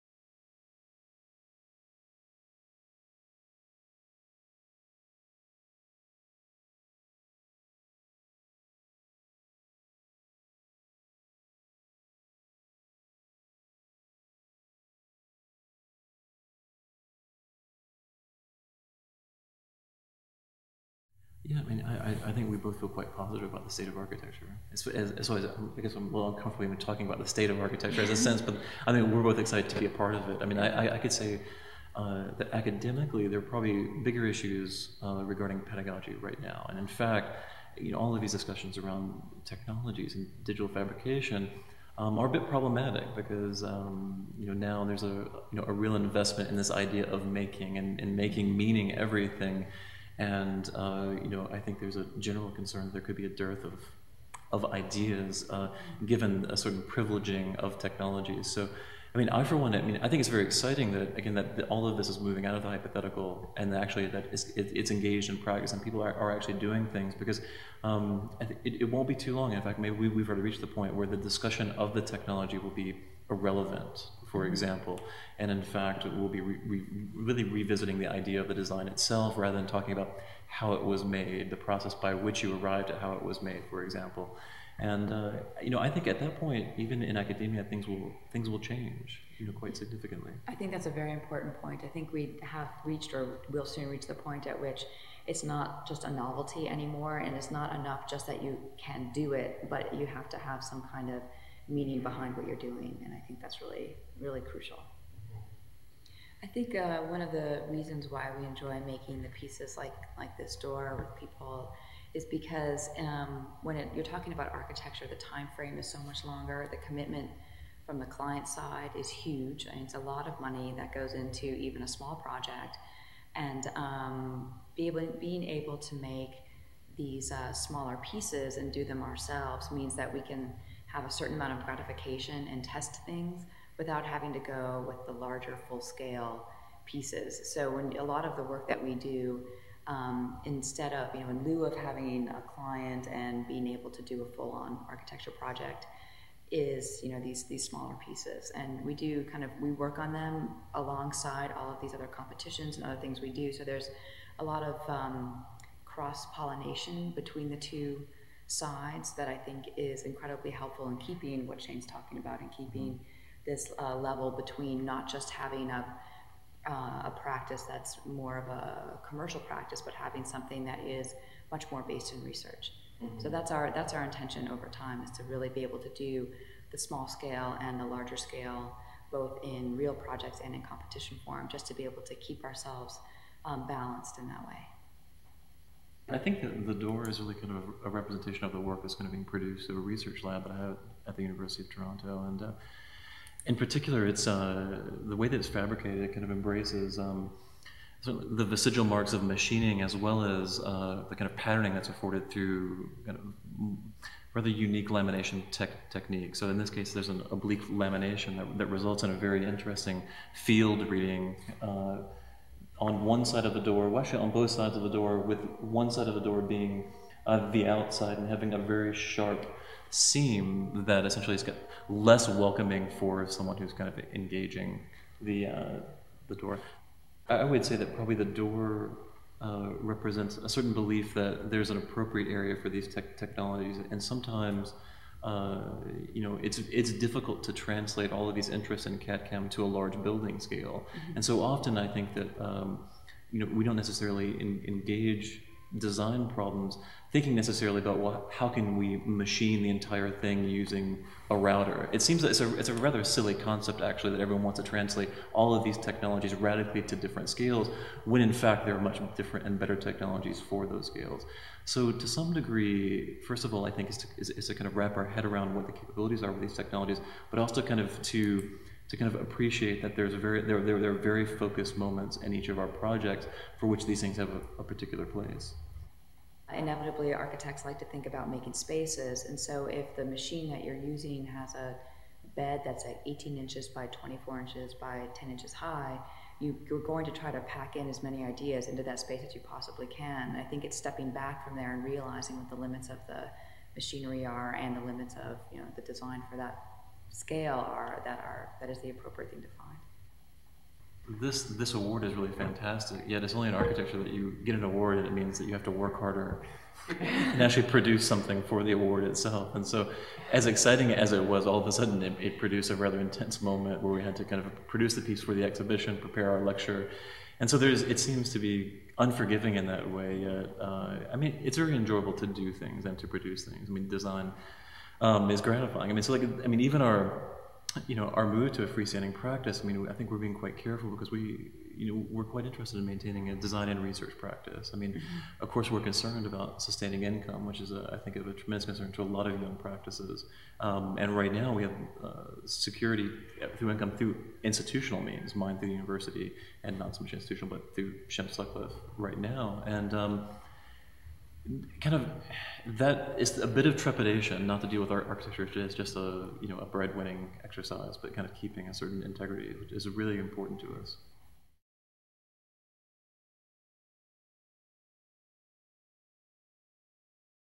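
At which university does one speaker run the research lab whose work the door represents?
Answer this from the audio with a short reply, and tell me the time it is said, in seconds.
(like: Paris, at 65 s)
University of Toronto, at 191 s.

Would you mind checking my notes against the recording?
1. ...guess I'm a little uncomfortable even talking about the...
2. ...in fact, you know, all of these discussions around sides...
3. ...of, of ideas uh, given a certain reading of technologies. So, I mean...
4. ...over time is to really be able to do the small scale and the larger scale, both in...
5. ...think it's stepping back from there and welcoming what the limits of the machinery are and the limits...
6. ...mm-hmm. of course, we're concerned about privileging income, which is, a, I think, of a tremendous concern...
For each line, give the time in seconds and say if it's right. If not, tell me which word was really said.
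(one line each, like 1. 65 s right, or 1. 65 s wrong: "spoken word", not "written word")
1. 25 s right
2. 36 s wrong: "technologies", not "sides"
3. 53 s wrong: "privileging", not "reading"
4. 174 s right
5. 290 s wrong: "realizing", not "welcoming"
6. 334 s wrong: "sustaining", not "privileging".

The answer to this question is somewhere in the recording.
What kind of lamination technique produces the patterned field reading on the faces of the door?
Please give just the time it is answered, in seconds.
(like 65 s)
207 s.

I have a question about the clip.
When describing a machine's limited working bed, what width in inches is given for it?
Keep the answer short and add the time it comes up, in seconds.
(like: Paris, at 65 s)
18 inches, at 283 s.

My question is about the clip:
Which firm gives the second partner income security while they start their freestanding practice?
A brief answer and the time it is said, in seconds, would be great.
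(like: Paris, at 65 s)
Shim Sutcliffe, at 348 s.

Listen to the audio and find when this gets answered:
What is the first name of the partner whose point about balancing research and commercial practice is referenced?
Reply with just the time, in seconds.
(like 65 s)
161 s.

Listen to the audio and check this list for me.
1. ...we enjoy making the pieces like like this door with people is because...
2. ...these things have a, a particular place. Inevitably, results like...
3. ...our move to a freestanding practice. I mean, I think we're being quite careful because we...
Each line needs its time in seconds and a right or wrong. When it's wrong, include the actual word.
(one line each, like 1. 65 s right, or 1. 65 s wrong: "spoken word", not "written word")
1. 108 s right
2. 273 s wrong: "architects", not "results"
3. 328 s right.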